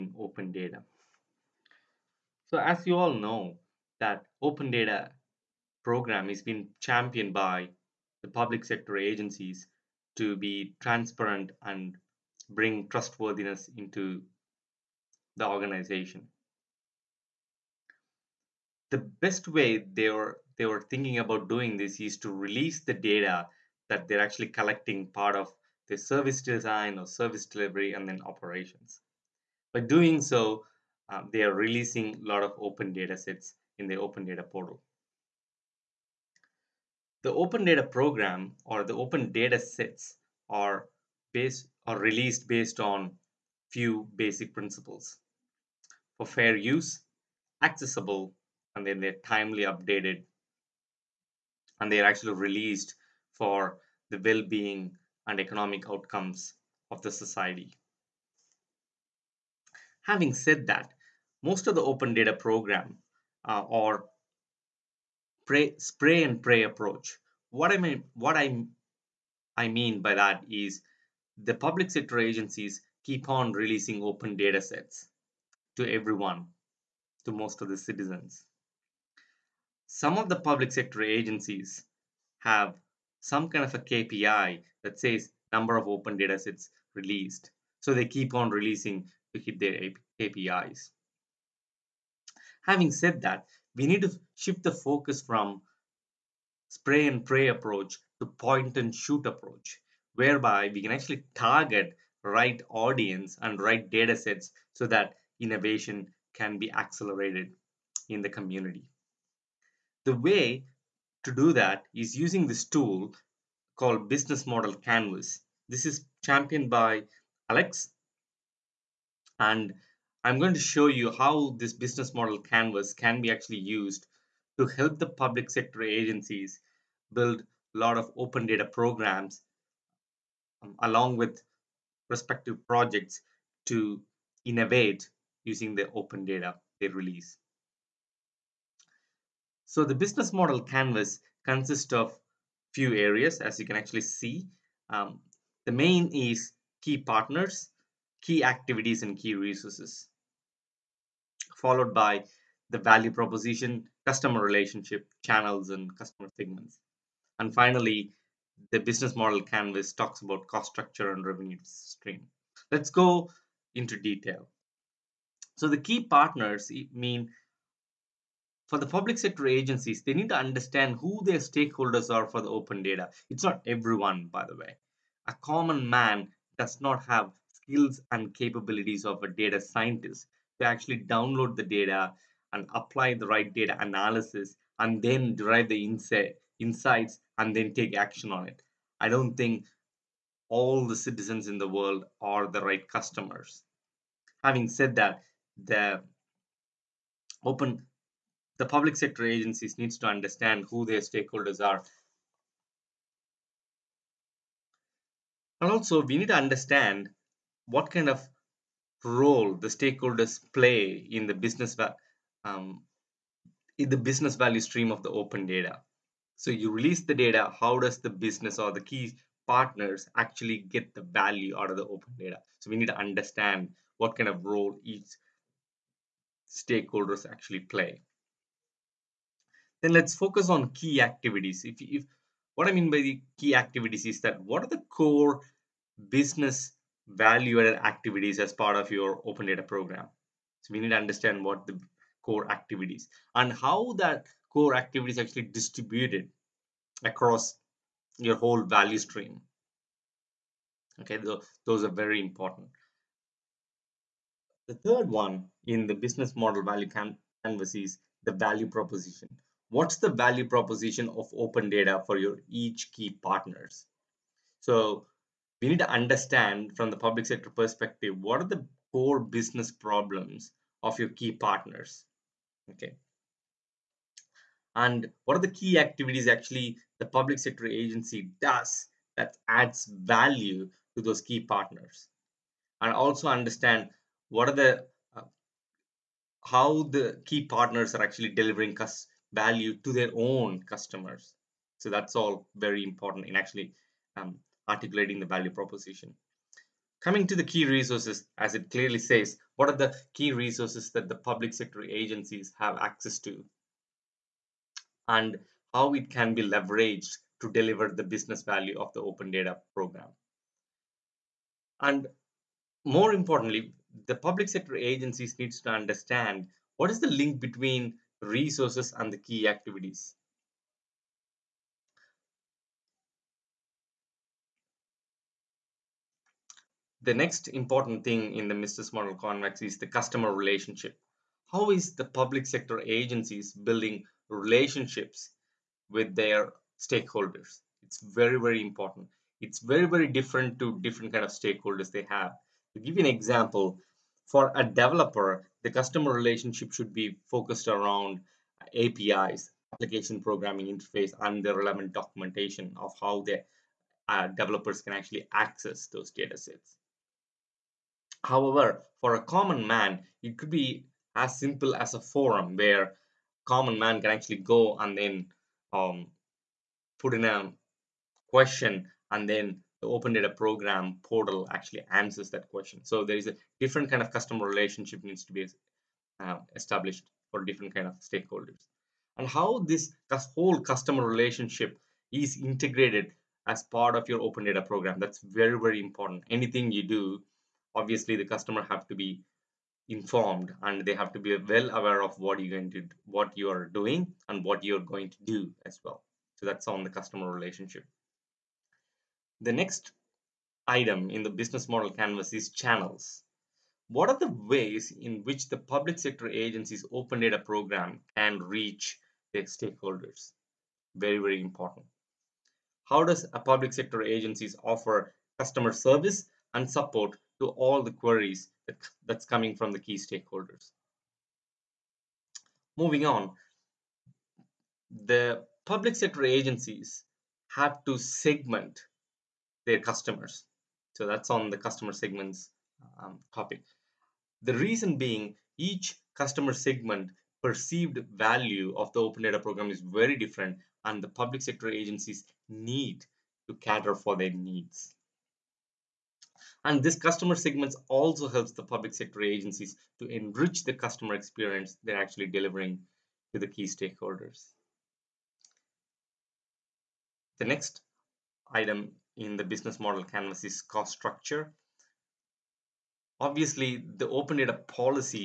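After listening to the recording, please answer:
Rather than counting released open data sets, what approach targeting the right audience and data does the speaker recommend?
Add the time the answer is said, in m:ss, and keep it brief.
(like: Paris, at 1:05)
Point and shoot, at 1:38.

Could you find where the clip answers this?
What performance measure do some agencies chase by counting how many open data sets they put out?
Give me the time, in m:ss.
1:23.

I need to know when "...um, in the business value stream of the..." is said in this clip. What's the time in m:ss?
3:32.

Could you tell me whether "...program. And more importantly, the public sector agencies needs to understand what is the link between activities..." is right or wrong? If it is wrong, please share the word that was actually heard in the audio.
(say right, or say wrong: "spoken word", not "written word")
wrong: "resources", not "activities".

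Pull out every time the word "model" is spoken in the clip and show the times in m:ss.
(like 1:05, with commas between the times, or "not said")
1:54, 2:02, 2:20, 2:39, 4:16, 5:28, 6:41, 7:39.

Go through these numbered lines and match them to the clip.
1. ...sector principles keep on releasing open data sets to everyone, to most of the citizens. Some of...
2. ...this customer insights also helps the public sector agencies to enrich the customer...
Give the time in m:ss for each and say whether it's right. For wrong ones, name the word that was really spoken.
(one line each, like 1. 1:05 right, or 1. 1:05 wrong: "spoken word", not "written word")
1. 1:11 wrong: "agencies", not "principles"
2. 7:26 wrong: "segments", not "insights".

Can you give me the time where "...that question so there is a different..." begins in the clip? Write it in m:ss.
6:12.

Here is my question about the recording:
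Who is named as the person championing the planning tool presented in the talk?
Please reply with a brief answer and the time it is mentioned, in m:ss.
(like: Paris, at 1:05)
Alex, at 1:57.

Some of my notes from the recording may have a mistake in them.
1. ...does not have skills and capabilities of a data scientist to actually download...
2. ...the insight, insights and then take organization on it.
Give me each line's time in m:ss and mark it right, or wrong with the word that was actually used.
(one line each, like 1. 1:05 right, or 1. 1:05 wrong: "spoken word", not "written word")
1. 2:56 right
2. 3:05 wrong: "action", not "organization".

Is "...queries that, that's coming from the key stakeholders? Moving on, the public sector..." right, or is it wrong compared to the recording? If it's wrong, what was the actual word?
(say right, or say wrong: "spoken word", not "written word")
right.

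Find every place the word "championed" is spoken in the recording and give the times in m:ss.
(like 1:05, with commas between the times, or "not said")
0:06, 1:56.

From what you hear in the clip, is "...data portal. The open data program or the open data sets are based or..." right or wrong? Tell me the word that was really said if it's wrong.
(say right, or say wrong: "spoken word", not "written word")
right.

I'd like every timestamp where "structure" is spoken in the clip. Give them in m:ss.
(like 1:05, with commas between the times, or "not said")
2:40, 7:40.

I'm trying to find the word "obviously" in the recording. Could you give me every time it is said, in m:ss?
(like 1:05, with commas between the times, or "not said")
6:27, 7:43.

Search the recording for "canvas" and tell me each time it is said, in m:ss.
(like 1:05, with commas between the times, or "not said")
1:54, 2:02, 2:20, 2:39, 4:16, 5:29, 6:41, 7:40.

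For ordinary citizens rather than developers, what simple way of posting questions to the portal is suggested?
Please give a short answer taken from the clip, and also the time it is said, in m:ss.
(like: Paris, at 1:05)
A forum, at 6:01.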